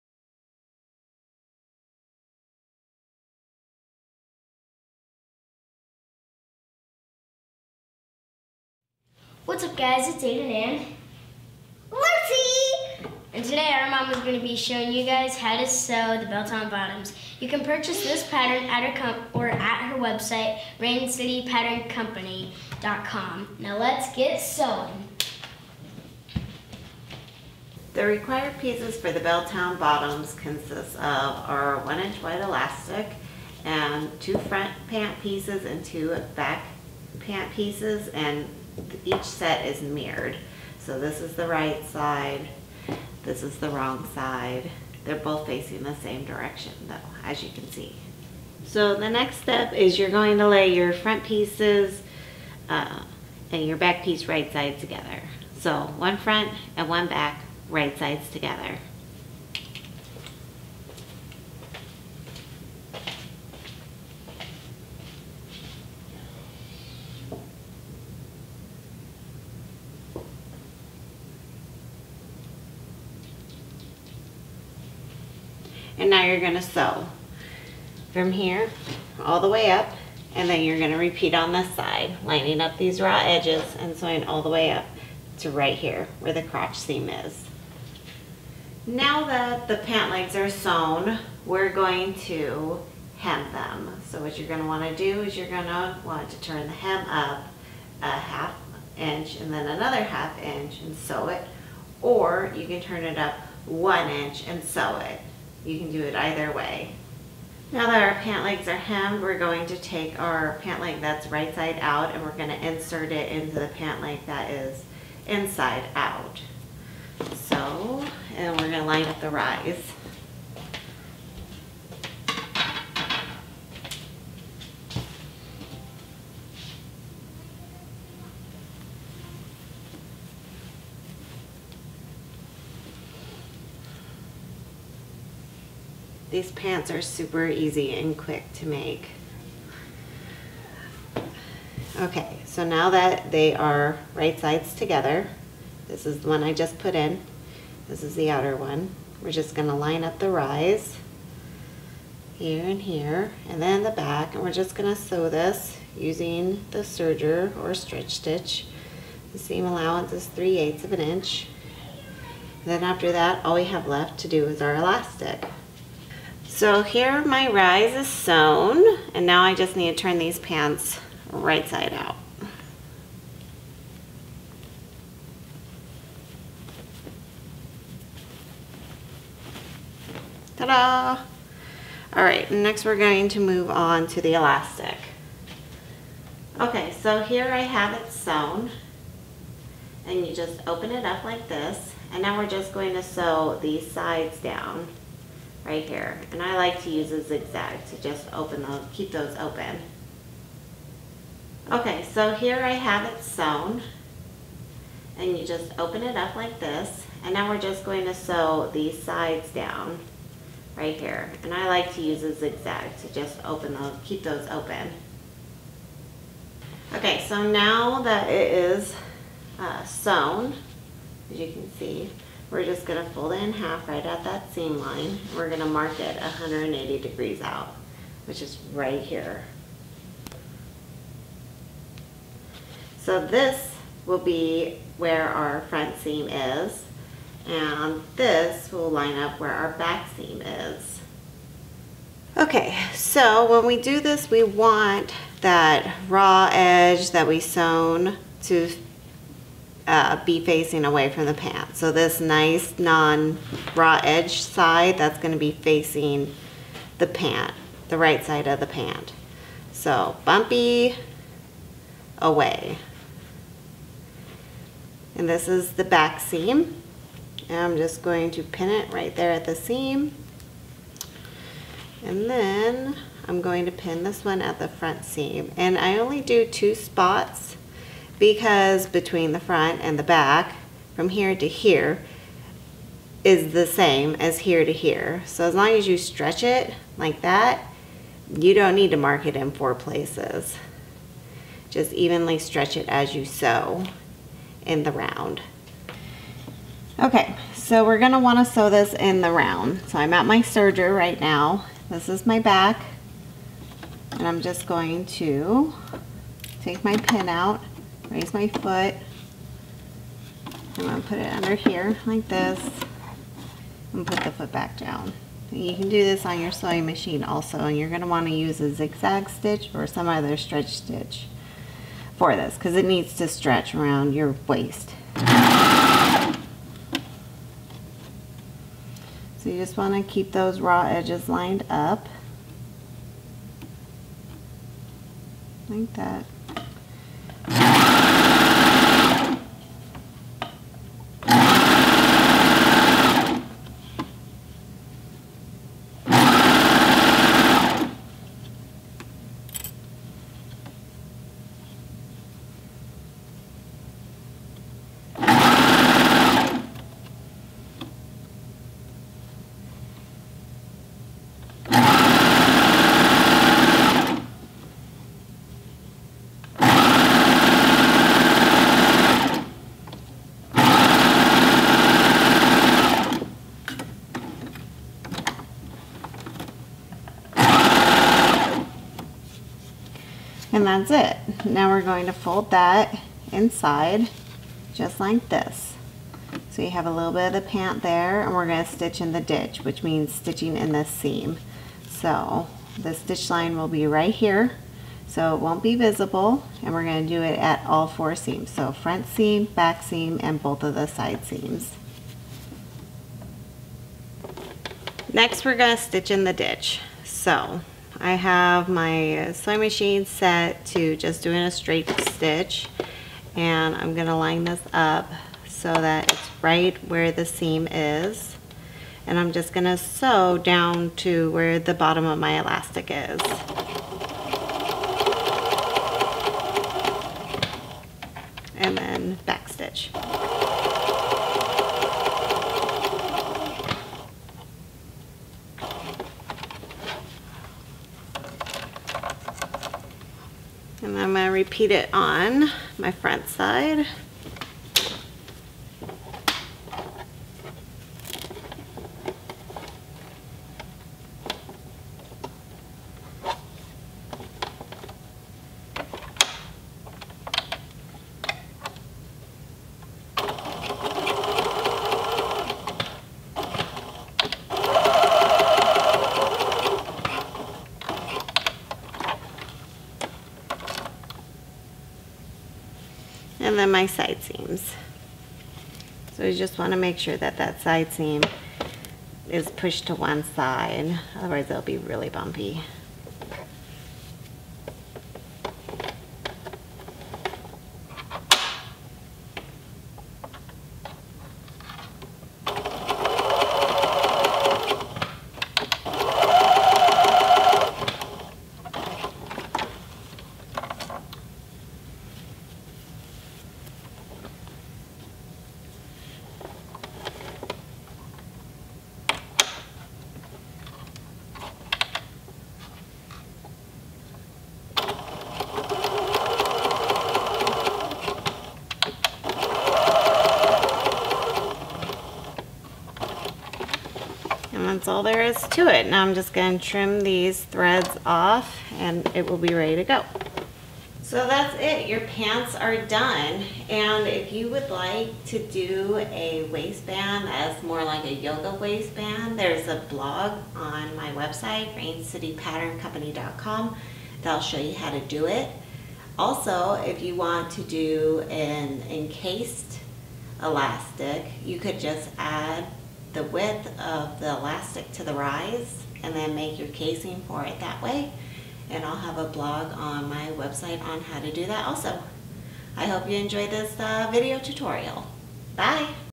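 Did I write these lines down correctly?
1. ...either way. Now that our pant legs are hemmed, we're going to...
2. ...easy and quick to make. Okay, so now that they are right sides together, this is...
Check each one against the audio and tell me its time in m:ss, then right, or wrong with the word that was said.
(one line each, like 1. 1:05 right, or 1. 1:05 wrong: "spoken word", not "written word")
1. 1:46 right
2. 2:17 right.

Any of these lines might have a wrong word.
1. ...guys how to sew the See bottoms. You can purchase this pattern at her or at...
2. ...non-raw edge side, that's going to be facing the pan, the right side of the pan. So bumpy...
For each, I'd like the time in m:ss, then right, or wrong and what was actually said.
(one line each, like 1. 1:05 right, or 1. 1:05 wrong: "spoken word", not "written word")
1. 0:15 wrong: "Belltown", not "See"
2. 4:12 right.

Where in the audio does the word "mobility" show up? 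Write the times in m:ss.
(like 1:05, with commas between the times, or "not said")
not said.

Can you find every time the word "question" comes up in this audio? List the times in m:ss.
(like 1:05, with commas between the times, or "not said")
not said.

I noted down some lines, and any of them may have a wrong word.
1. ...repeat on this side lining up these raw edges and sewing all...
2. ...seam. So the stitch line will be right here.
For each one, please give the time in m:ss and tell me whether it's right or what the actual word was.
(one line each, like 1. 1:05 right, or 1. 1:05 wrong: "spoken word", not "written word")
1. 1:20 right
2. 6:30 right.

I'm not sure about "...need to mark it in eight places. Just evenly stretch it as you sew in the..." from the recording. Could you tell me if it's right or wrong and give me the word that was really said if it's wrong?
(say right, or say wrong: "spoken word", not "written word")
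wrong: "four", not "eight".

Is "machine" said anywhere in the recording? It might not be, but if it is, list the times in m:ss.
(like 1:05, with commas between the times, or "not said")
5:16, 6:49.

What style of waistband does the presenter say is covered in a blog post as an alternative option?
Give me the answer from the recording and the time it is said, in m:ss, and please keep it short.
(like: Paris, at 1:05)
Yoga waistband, at 8:58.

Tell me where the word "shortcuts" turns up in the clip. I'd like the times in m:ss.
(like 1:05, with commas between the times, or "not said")
not said.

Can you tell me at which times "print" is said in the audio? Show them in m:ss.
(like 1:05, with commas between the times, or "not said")
not said.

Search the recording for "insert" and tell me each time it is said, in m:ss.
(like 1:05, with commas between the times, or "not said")
1:52.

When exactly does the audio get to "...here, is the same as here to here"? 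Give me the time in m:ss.
4:41.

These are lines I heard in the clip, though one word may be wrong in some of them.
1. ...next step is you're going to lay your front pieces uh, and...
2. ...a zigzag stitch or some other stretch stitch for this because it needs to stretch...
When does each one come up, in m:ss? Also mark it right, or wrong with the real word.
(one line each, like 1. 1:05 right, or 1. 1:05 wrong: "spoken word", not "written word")
1. 0:49 right
2. 5:18 right.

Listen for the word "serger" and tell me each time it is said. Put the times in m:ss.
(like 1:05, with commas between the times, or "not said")
2:36, 5:00.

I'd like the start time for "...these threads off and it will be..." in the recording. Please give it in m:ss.
8:47.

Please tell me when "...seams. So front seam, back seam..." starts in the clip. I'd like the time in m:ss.
6:38.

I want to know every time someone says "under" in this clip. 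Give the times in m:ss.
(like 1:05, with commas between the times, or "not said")
5:11.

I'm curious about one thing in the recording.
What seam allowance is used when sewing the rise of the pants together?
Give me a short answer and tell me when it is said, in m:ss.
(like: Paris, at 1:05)
3/8 inch, at 2:40.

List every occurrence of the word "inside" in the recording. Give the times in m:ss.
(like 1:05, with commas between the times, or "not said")
1:55, 6:23.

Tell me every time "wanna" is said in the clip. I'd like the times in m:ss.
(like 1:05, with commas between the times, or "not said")
4:58.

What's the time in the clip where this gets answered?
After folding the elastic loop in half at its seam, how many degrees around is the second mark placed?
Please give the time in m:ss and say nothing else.
3:46.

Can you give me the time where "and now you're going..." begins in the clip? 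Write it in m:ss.
1:15.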